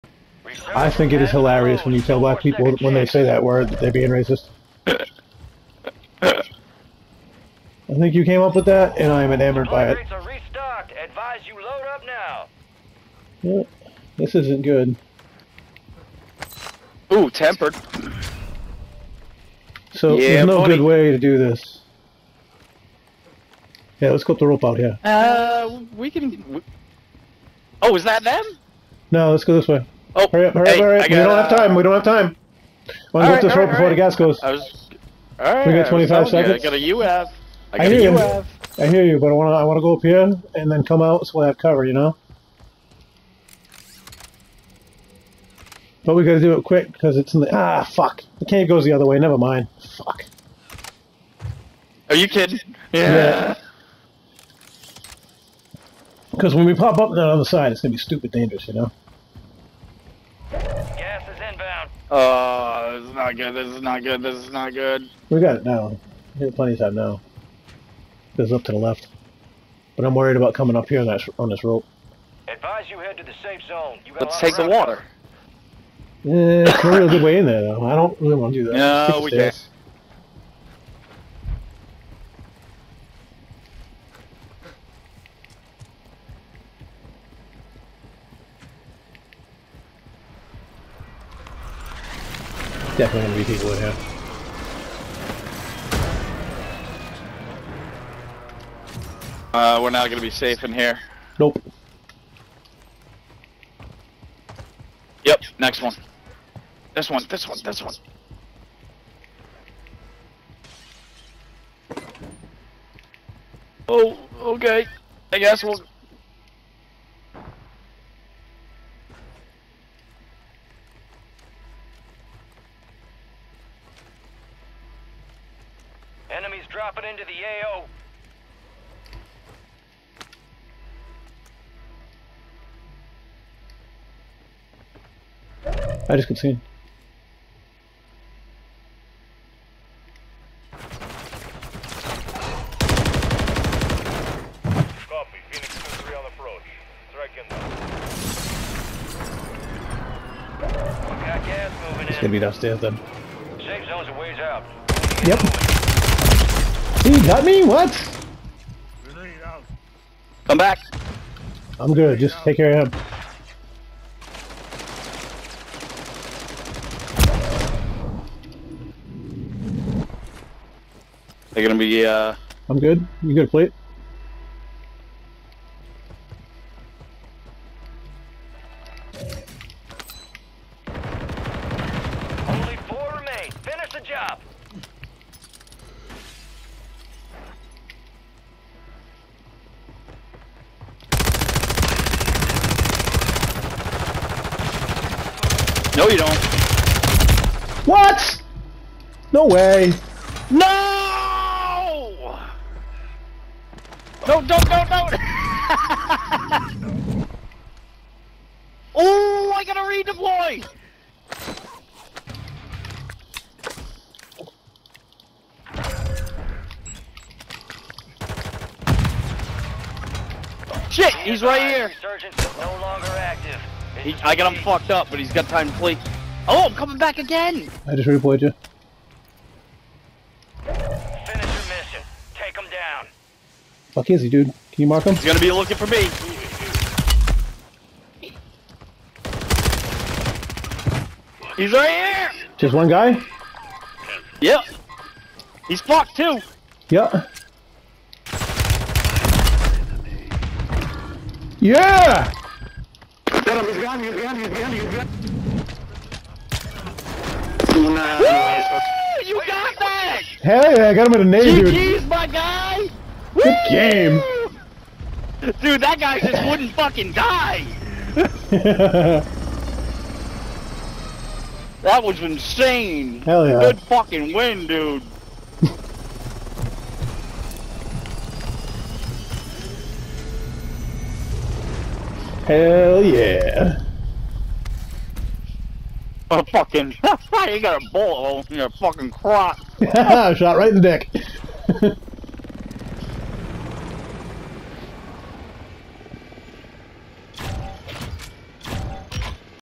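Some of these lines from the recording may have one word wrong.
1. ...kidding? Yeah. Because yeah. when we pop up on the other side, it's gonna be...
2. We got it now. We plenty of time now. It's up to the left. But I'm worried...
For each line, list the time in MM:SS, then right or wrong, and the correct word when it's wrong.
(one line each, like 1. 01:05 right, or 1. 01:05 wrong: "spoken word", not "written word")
1. 00:52 right
2. 01:05 right.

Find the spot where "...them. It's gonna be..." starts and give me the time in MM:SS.
02:31.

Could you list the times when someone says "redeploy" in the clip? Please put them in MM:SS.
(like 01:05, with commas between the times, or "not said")
03:29.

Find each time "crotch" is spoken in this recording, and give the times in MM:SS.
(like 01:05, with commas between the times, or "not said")
04:49.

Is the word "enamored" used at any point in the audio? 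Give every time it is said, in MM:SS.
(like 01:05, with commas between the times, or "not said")
00:09.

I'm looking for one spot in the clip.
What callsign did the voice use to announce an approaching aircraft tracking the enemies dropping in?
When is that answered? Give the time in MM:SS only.
02:25.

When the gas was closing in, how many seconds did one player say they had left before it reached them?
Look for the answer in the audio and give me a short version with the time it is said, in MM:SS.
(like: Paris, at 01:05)
25, at 00:35.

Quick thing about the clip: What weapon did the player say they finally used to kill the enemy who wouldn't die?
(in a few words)
a nade.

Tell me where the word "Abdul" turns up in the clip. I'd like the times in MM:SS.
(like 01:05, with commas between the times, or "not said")
not said.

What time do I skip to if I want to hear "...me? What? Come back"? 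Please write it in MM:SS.
02:37.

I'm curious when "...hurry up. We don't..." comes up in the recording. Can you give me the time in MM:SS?
00:30.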